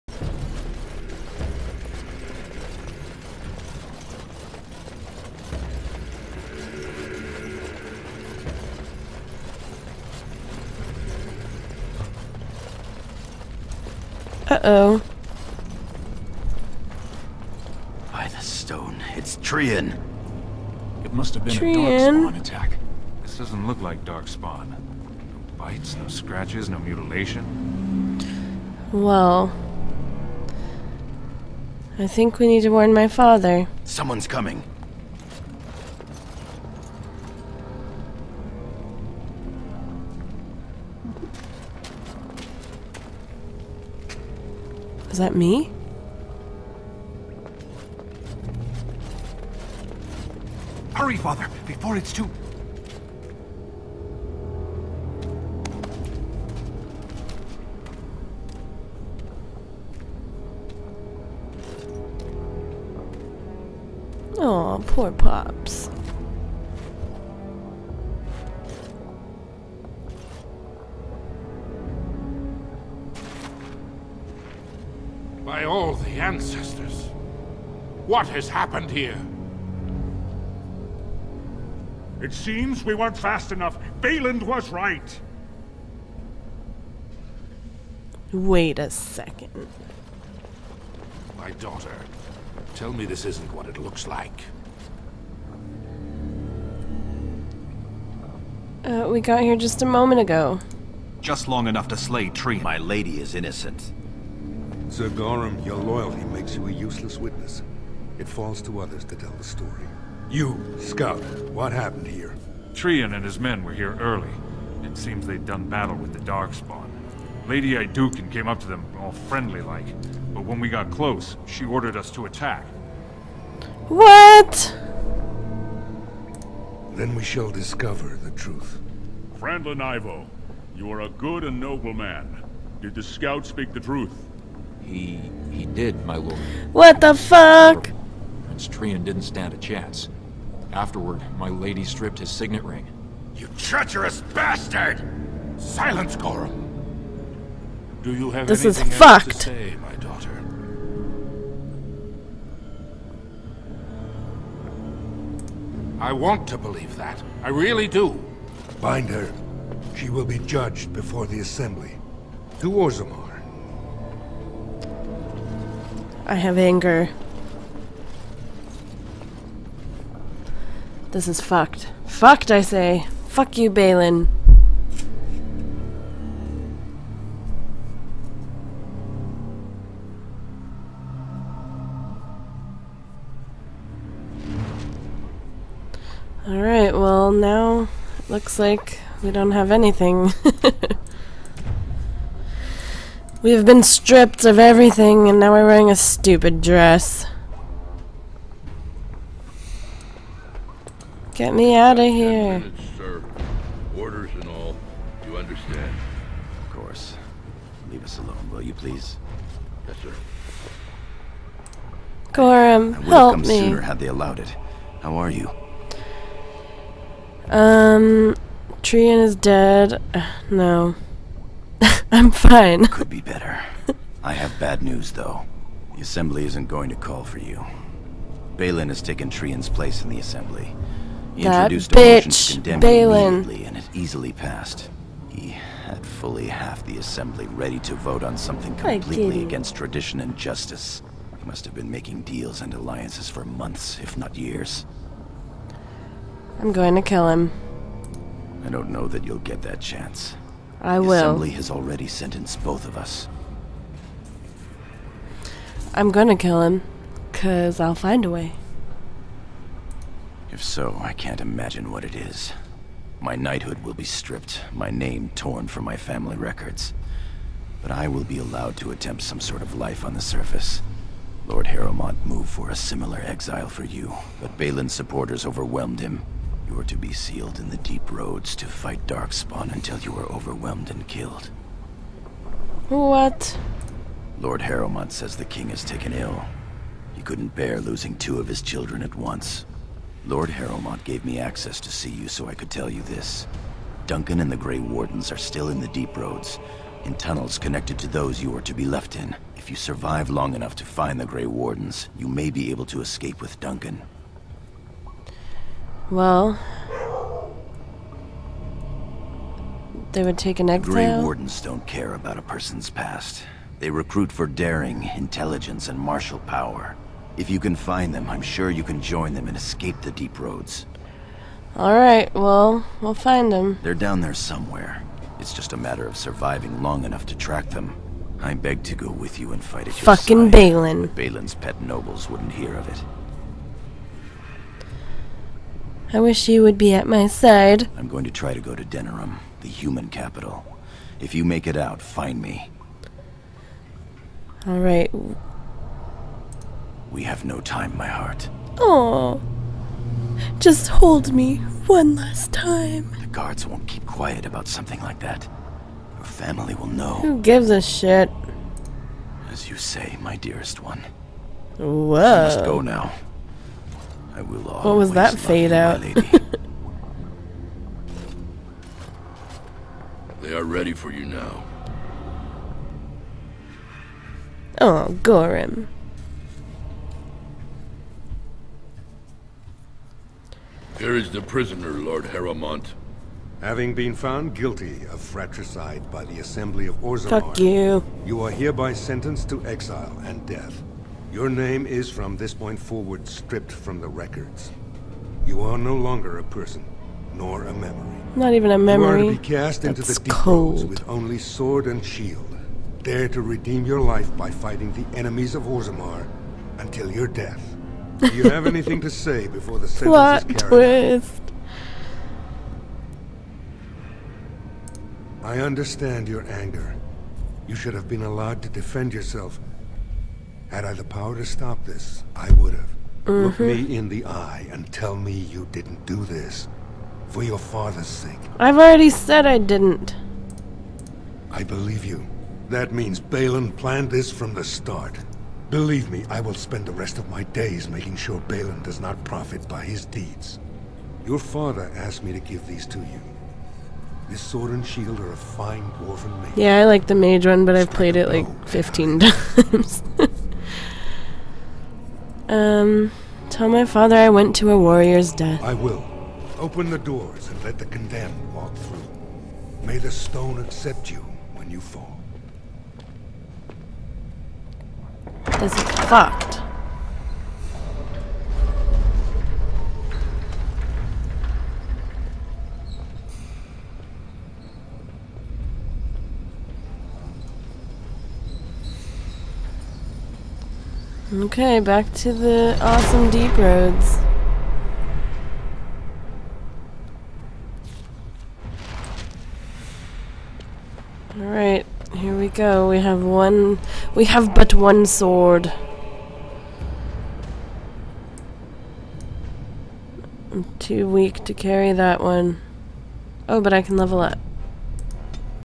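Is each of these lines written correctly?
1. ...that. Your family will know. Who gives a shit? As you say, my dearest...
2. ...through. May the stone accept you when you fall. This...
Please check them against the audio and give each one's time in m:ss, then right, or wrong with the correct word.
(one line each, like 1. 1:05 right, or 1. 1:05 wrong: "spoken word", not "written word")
1. 5:55 right
2. 7:38 right.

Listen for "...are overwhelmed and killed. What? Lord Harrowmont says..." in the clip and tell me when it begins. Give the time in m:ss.
4:40.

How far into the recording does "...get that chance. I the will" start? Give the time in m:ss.
4:09.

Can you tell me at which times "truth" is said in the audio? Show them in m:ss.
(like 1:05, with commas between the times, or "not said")
2:08, 2:13.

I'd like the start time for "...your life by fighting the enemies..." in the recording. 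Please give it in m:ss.
6:43.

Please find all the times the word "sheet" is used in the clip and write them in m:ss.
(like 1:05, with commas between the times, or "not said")
not said.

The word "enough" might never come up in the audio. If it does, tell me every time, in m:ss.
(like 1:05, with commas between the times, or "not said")
1:23, 1:41, 5:00, 5:27.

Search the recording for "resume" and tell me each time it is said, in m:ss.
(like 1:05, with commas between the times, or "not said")
not said.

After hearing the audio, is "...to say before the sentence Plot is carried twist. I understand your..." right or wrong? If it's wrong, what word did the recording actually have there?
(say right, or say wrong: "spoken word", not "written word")
right.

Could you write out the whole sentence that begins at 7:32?
Um, tell my father I went to a warrior's death.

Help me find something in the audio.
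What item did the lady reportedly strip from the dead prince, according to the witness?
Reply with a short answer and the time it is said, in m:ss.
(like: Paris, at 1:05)
Signet ring, at 2:22.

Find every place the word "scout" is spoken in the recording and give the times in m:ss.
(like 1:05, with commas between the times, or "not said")
1:50, 2:13.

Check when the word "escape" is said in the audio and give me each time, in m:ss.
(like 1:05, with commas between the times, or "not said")
5:03, 5:19.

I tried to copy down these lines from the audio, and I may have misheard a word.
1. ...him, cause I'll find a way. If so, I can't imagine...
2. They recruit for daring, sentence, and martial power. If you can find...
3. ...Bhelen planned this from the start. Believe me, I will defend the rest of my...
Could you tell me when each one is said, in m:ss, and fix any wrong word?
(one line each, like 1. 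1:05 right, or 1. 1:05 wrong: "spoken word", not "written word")
1. 4:16 right
2. 5:13 wrong: "intelligence", not "sentence"
3. 7:13 wrong: "spend", not "defend".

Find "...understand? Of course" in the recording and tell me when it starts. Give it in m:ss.
3:25.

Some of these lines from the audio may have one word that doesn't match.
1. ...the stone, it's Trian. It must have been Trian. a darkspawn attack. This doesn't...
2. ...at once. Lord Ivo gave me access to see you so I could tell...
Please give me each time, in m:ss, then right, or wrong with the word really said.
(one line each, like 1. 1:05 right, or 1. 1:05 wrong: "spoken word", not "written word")
1. 0:18 right
2. 4:49 wrong: "Harrowmont", not "Ivo".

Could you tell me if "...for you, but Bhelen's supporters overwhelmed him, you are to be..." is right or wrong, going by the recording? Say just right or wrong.
right.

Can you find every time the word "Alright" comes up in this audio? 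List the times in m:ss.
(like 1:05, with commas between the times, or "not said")
3:06, 5:21, 8:11.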